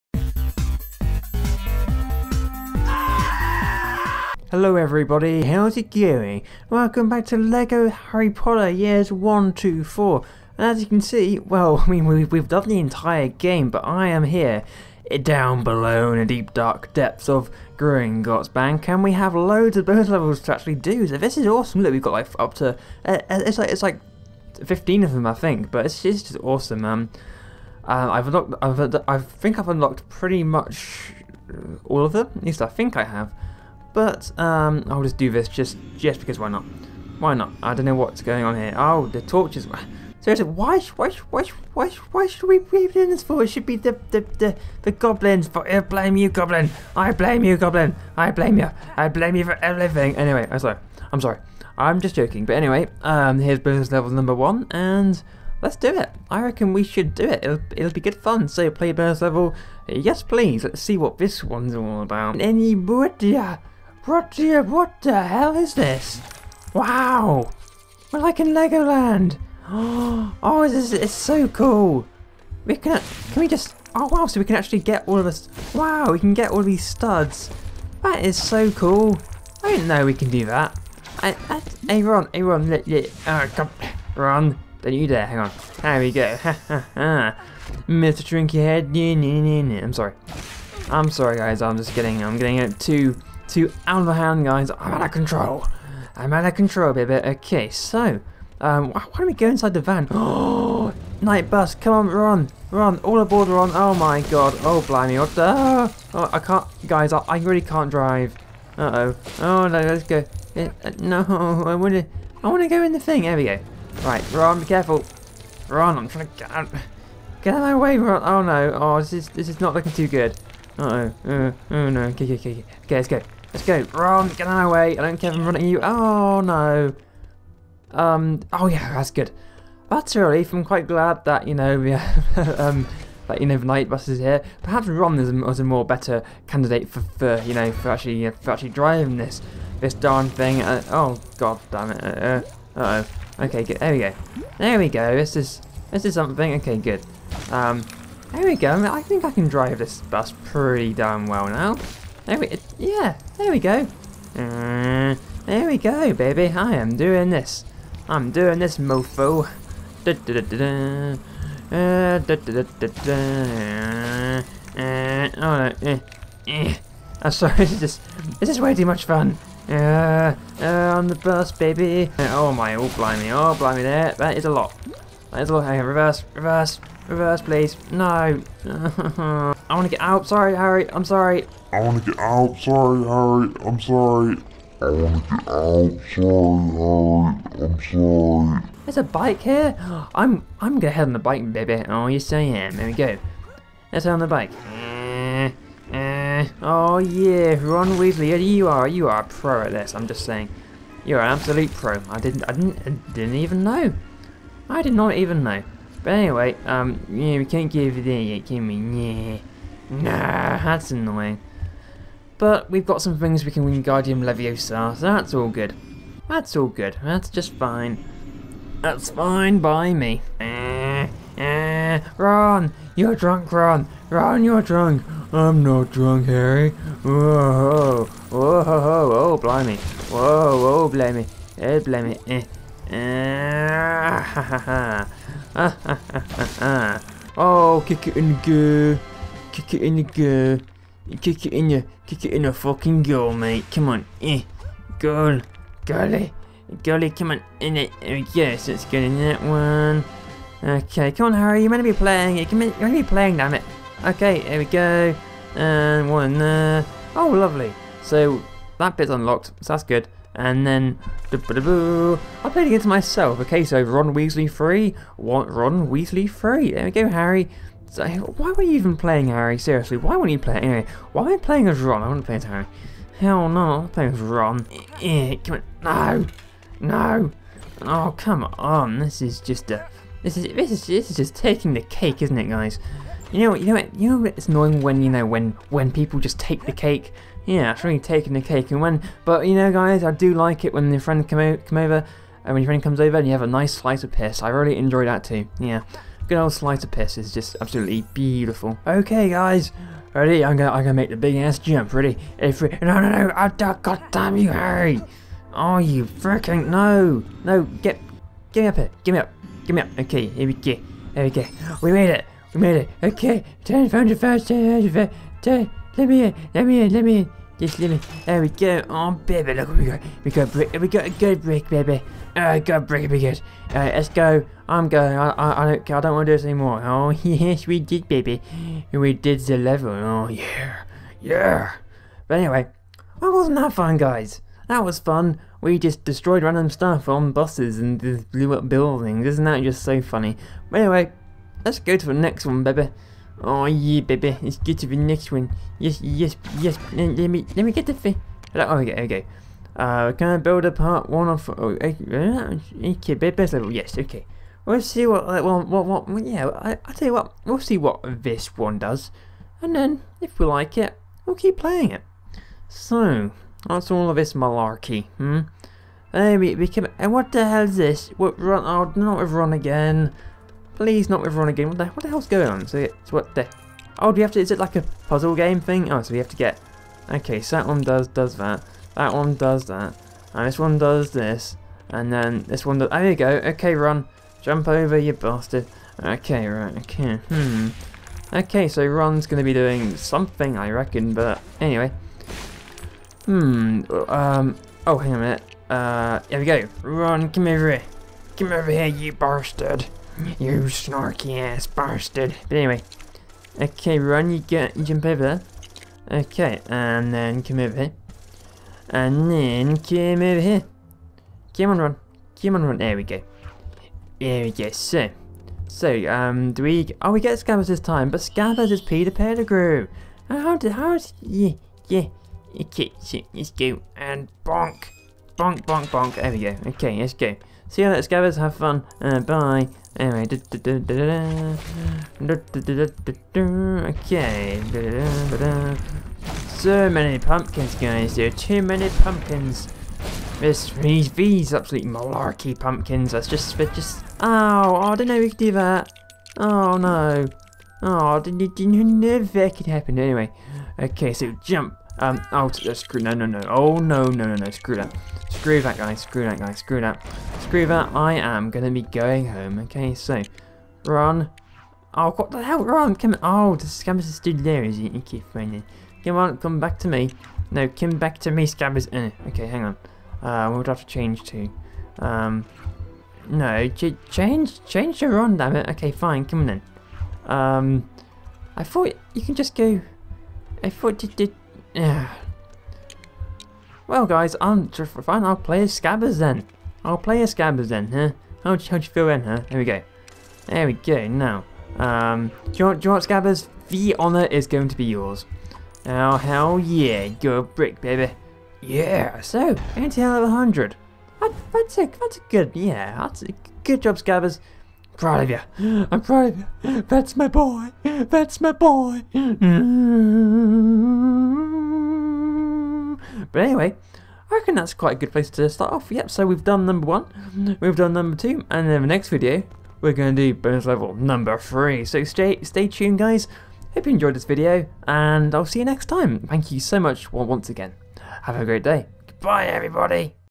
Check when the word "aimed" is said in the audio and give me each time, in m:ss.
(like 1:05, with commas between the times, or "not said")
not said.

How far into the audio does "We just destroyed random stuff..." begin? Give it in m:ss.
5:35.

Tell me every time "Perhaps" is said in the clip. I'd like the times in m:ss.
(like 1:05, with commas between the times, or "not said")
2:14.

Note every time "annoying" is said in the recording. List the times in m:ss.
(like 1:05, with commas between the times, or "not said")
3:30, 4:44.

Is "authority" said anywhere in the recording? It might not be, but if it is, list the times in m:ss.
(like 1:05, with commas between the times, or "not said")
not said.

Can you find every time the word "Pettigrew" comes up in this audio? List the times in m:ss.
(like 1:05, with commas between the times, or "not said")
6:59.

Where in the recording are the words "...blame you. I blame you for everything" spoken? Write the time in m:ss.
0:48.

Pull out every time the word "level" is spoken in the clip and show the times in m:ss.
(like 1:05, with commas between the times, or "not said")
0:20, 0:53, 0:59, 5:29, 5:53, 8:40.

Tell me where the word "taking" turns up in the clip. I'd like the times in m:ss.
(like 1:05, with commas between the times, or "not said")
4:41, 4:47.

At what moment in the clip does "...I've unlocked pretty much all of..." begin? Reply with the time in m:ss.
0:29.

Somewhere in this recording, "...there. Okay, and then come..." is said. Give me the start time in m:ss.
6:45.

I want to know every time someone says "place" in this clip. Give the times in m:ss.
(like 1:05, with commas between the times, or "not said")
8:35.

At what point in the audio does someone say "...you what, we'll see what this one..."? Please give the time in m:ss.
5:57.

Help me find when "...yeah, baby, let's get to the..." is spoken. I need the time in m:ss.
5:43.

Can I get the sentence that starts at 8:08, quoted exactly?
How'd you, how'd you feel then, huh?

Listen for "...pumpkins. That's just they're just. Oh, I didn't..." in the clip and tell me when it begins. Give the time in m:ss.
7:22.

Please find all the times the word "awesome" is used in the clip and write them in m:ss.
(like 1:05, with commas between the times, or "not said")
0:21, 0:26.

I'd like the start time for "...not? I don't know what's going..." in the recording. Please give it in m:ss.
0:37.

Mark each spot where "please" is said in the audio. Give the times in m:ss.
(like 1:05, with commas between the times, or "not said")
1:00, 2:57, 6:10.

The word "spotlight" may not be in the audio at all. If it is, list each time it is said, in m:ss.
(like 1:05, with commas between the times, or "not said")
not said.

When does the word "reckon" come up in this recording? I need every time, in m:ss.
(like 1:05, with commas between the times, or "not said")
0:56, 6:30, 8:34.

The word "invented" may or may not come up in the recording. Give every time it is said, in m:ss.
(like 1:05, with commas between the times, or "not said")
not said.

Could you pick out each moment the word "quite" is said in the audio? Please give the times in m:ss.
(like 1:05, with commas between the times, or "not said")
2:10, 8:34.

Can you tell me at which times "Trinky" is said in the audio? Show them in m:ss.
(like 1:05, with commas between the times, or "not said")
1:28.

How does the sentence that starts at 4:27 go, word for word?
So, why were you even playing Harry?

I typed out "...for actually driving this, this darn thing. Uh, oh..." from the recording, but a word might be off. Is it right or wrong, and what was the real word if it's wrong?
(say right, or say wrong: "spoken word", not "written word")
right.